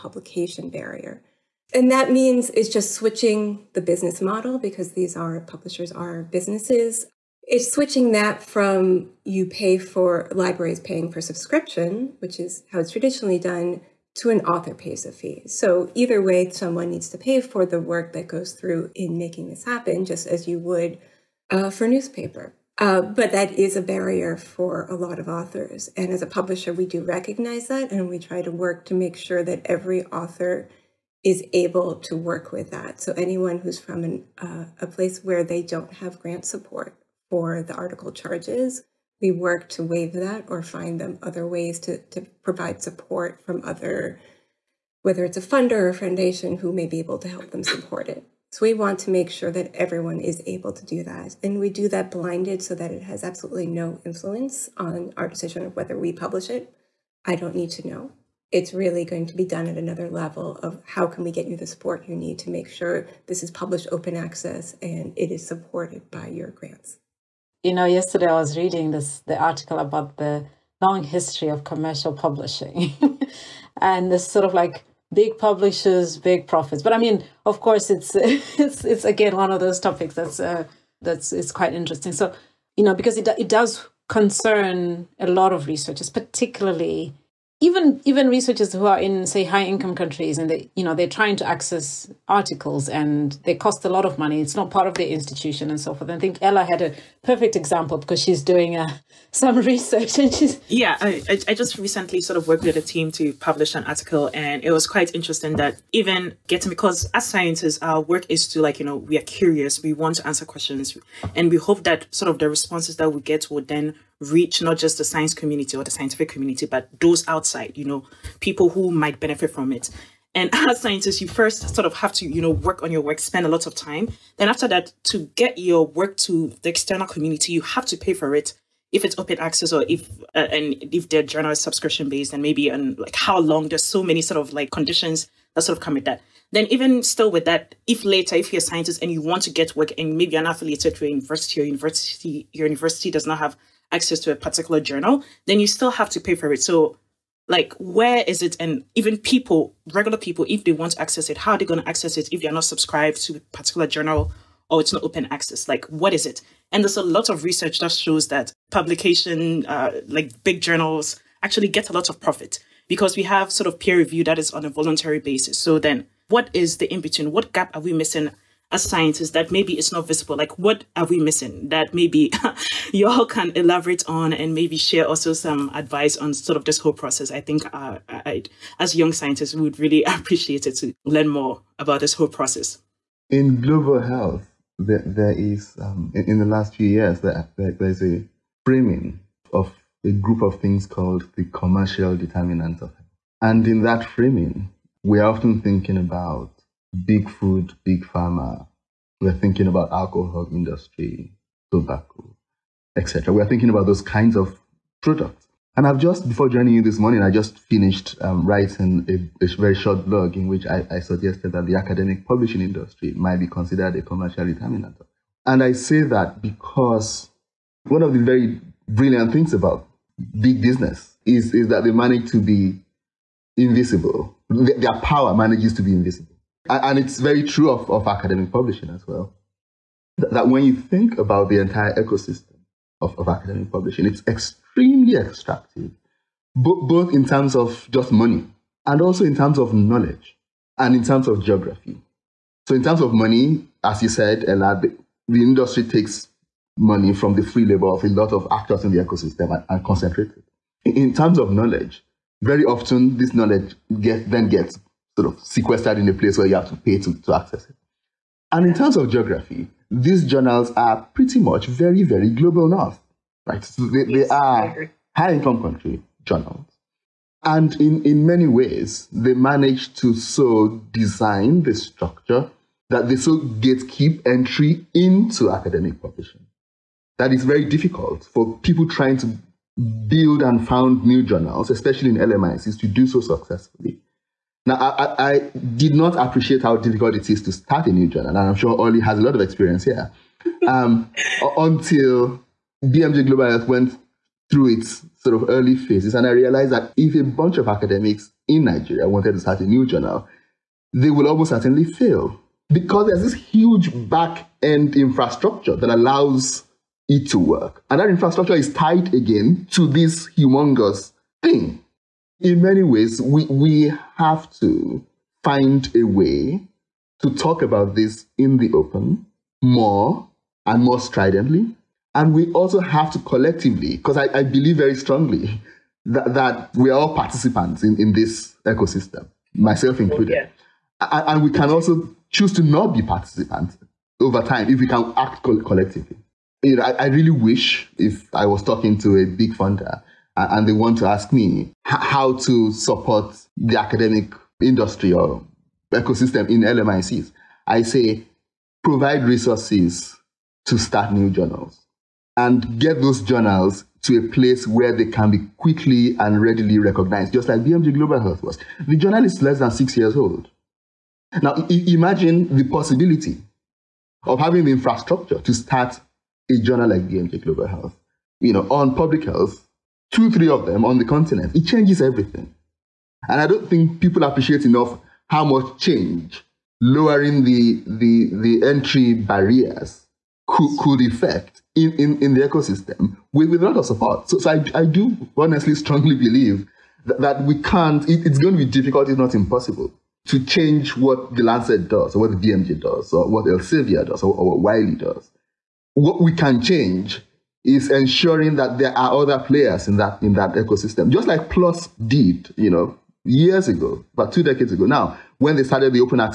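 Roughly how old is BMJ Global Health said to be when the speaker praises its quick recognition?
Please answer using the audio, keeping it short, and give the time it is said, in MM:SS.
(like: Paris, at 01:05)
Less than 6 years, at 05:59.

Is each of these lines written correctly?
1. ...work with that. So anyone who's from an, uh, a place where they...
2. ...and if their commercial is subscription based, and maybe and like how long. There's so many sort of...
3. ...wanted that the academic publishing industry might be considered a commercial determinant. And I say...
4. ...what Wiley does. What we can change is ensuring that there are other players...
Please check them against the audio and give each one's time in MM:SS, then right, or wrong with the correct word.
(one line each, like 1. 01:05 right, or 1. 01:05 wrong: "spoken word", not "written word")
1. 00:32 right
2. 02:10 wrong: "journal", not "commercial"
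3. 03:30 wrong: "suggested", not "wanted"
4. 06:34 right.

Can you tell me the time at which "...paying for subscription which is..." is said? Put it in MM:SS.
00:10.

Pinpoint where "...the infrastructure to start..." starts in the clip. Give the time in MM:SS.
06:04.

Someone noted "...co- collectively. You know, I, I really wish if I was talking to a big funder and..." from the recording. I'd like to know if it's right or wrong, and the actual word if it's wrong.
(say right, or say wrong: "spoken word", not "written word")
right.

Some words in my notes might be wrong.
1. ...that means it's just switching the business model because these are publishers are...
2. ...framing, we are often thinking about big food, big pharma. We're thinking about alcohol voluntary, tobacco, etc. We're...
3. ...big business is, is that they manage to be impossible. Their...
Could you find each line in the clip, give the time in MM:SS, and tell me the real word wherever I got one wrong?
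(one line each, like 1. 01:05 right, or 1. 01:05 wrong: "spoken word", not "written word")
1. 00:01 right
2. 03:14 wrong: "industry", not "voluntary"
3. 03:40 wrong: "invisible", not "impossible".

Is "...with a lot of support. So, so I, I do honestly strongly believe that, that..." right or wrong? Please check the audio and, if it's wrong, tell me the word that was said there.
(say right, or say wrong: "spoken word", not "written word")
right.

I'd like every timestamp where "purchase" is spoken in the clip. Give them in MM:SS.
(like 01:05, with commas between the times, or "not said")
not said.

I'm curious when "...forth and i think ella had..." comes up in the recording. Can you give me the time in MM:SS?
01:35.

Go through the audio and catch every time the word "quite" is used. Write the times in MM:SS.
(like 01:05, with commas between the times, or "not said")
01:21, 01:44.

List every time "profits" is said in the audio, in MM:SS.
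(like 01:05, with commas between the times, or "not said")
01:16, 02:42.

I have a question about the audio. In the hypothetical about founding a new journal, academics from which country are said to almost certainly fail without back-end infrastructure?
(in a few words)
Nigeria.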